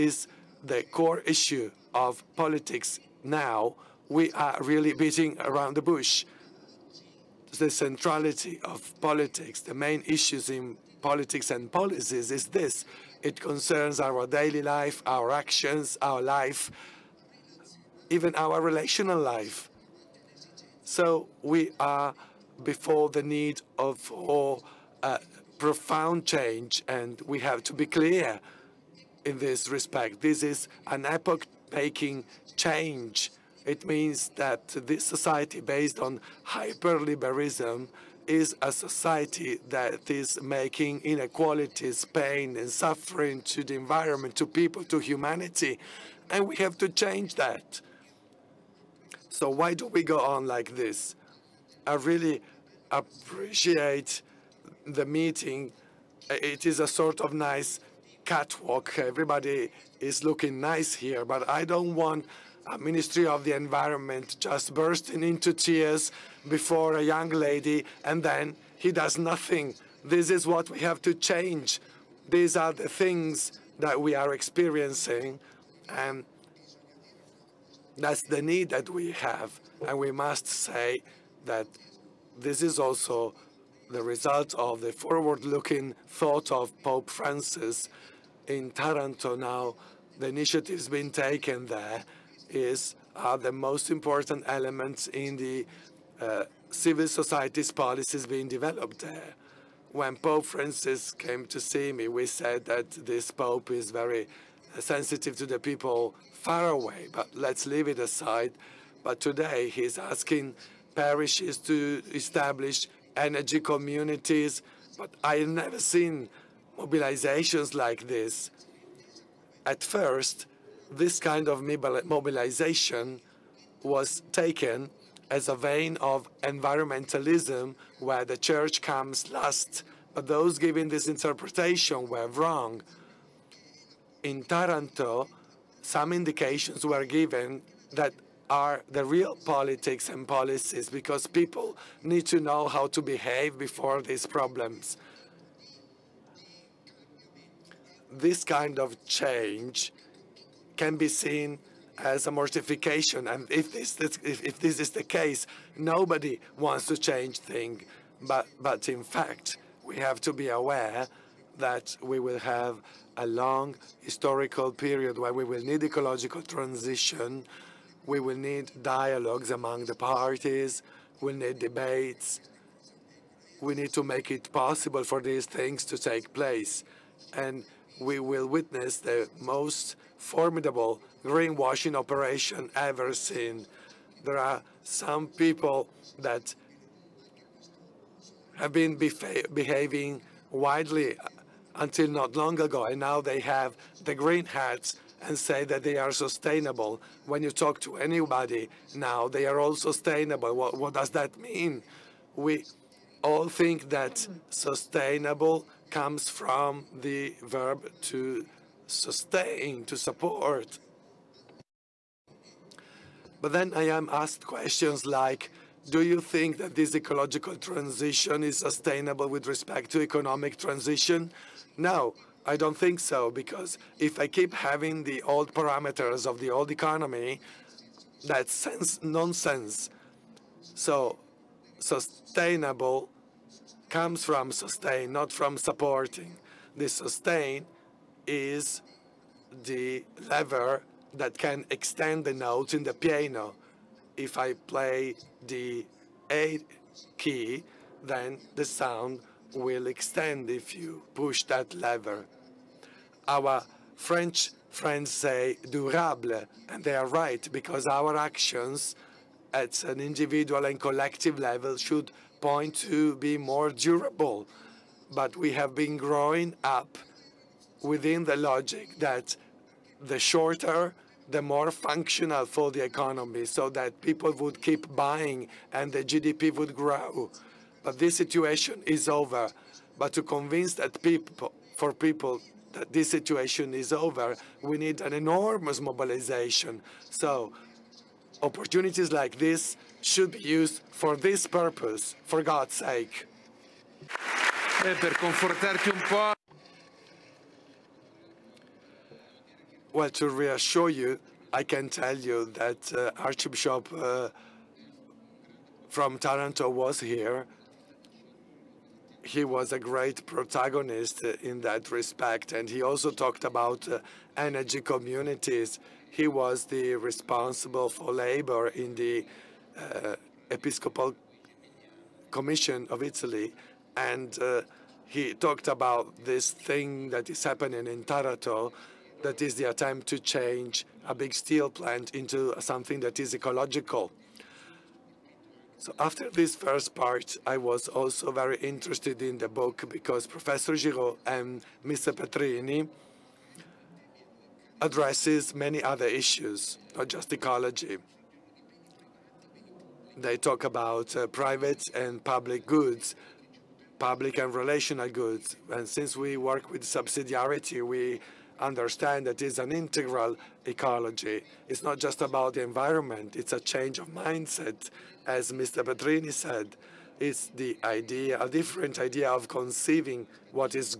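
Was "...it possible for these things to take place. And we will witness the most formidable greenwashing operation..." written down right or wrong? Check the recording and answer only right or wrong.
right.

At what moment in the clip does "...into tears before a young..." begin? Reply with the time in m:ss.
1:05.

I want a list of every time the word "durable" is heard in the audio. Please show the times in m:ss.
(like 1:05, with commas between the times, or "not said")
4:15, 4:23.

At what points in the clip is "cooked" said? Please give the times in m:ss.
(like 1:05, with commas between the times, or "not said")
not said.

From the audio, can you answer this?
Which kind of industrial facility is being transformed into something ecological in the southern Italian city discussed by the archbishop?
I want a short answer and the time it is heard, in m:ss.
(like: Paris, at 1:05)
steel plant, at 5:31.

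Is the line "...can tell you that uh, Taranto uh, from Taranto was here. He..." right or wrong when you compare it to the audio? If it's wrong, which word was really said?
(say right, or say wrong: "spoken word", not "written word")
wrong: "Archbishop", not "Taranto".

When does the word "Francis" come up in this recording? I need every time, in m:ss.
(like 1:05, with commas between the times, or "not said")
1:27, 1:40.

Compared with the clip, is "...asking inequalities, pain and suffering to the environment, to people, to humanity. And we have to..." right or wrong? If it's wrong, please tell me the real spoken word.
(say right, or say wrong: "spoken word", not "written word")
wrong: "making", not "asking".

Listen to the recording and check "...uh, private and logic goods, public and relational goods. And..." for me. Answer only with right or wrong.
wrong.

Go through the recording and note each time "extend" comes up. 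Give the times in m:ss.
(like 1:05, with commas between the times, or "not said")
4:01, 4:09.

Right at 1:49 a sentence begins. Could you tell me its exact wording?
But today he's asking parishes to establish energy communities, but I've never seen mobilizations like this.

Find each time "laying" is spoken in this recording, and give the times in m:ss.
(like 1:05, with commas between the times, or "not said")
not said.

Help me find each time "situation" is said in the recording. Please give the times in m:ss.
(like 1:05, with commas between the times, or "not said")
4:38, 4:43.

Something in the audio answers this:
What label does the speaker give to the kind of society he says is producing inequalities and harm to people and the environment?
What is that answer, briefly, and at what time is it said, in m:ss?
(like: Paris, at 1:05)
hyperliberalism, at 0:36.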